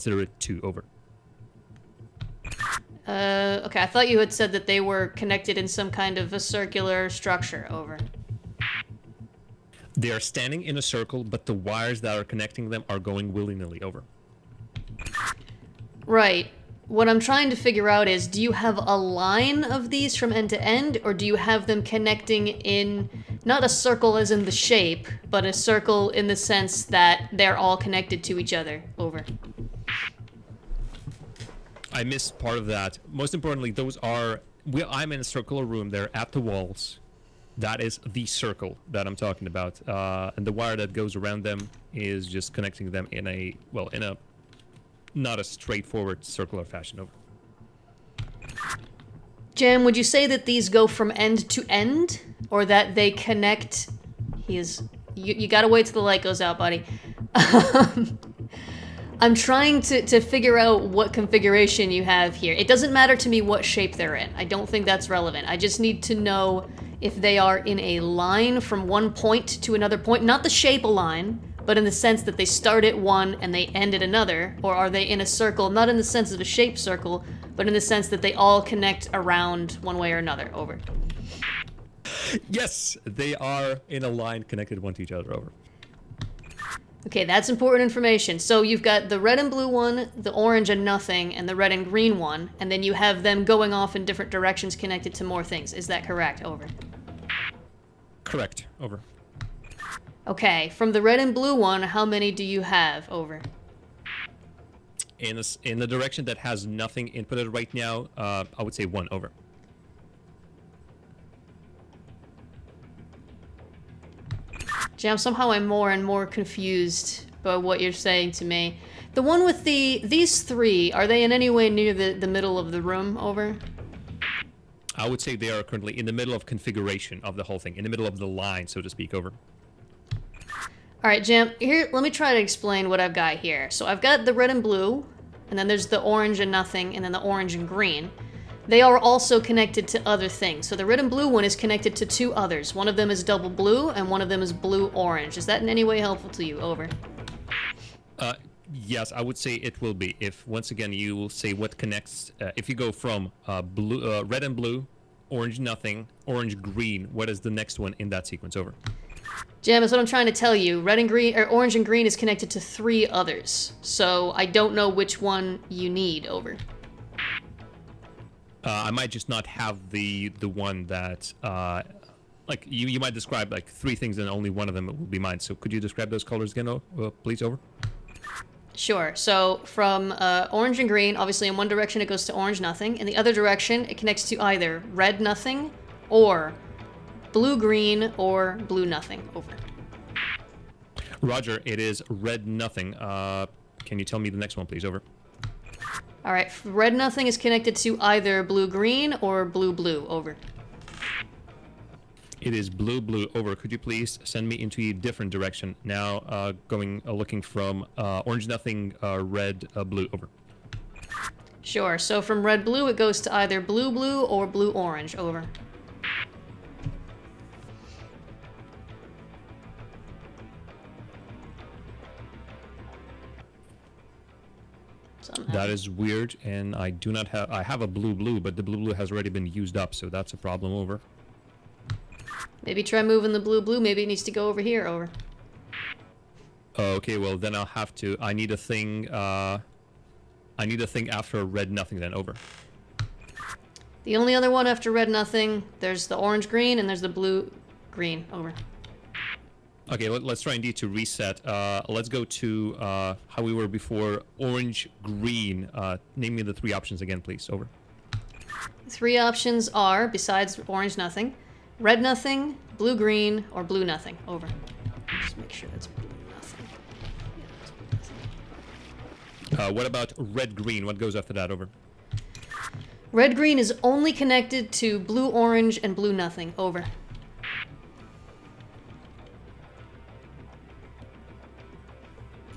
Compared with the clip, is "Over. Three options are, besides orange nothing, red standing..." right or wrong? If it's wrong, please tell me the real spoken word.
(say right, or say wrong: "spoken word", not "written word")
wrong: "nothing", not "standing".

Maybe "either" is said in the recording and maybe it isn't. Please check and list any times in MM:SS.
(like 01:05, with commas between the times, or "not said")
03:04, 03:17, 03:33.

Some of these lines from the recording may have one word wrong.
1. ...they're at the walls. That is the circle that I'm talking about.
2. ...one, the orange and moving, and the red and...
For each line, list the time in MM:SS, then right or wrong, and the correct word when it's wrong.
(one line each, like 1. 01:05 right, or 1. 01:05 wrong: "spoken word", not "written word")
1. 00:35 right
2. 01:29 wrong: "nothing", not "moving".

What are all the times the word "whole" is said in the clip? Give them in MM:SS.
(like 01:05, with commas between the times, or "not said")
02:07.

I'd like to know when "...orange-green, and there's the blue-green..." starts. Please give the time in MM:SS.
04:06.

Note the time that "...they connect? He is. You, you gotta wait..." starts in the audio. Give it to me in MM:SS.
00:52.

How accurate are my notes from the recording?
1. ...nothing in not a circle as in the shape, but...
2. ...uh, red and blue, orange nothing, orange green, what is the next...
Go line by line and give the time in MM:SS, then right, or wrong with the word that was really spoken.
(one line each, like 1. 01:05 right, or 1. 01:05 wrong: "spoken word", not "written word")
1. 00:21 wrong: "connecting", not "nothing"
2. 02:34 right.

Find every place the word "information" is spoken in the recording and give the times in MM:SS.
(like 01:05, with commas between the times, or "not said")
01:27.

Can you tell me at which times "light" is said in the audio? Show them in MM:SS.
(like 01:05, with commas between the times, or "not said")
00:56.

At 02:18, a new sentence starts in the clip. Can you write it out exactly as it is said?
They are also connected to other things.